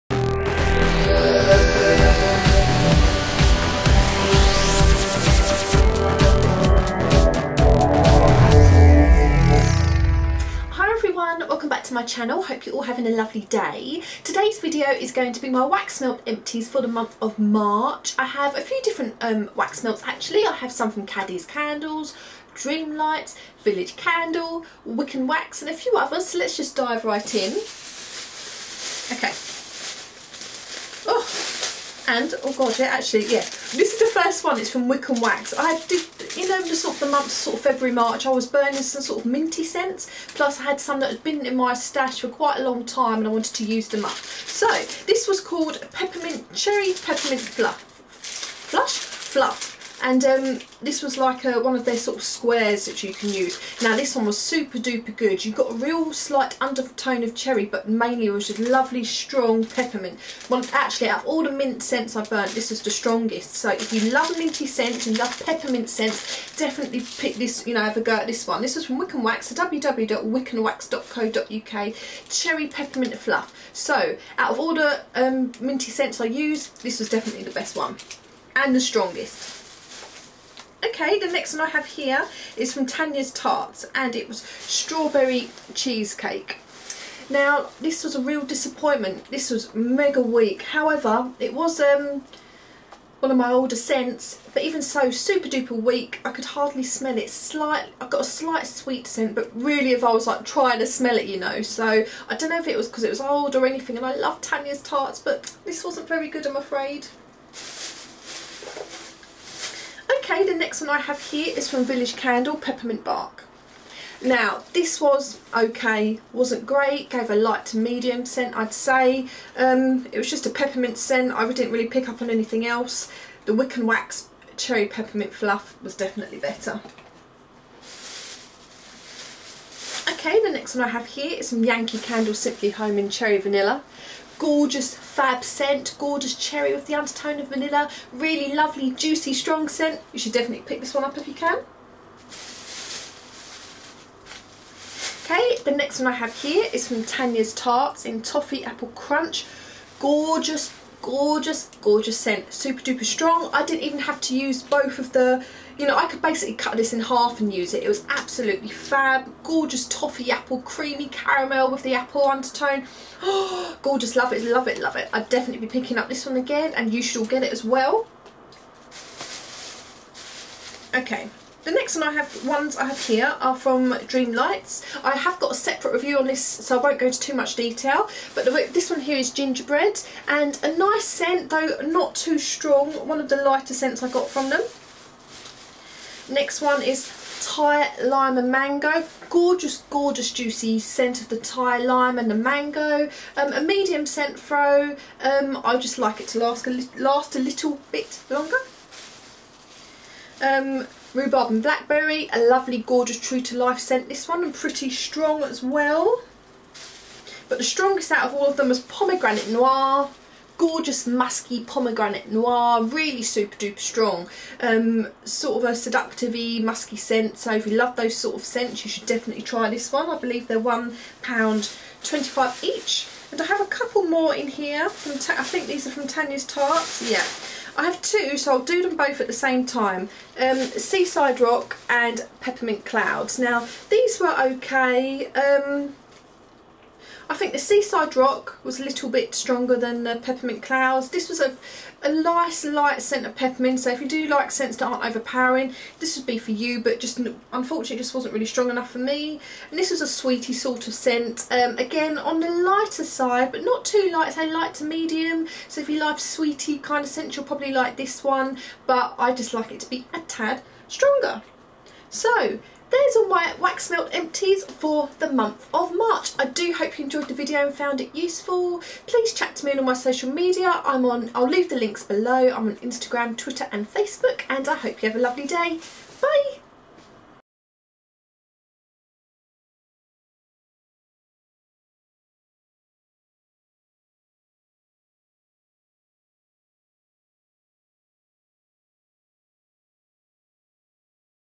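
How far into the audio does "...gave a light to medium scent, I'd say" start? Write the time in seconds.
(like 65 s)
117 s.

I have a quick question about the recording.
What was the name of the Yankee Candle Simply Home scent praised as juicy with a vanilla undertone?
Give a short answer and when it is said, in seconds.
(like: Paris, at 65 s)
Cherry Vanilla, at 133 s.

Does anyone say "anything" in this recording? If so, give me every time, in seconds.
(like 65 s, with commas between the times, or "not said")
103 s, 122 s.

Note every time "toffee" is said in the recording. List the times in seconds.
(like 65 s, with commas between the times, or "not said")
148 s, 159 s.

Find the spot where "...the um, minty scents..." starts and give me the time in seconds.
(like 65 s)
74 s.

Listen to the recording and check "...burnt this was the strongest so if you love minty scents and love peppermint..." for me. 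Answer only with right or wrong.
right.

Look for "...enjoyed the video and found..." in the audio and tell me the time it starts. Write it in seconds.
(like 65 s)
267 s.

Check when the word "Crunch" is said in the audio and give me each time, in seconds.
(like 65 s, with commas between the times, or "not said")
148 s.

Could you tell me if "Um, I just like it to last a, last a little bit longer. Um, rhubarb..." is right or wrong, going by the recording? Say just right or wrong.
right.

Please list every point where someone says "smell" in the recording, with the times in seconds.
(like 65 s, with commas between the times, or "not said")
96 s, 100 s.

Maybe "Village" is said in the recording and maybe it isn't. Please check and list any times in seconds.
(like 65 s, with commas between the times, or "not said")
23 s, 111 s.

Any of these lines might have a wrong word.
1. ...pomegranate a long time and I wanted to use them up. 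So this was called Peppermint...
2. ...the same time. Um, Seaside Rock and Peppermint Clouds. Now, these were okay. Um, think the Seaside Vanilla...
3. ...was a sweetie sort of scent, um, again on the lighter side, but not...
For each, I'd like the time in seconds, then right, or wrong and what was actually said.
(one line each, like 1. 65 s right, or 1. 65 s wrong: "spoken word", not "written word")
1. 42 s wrong: "quite", not "pomegranate"
2. 229 s wrong: "Rock", not "Vanilla"
3. 249 s right.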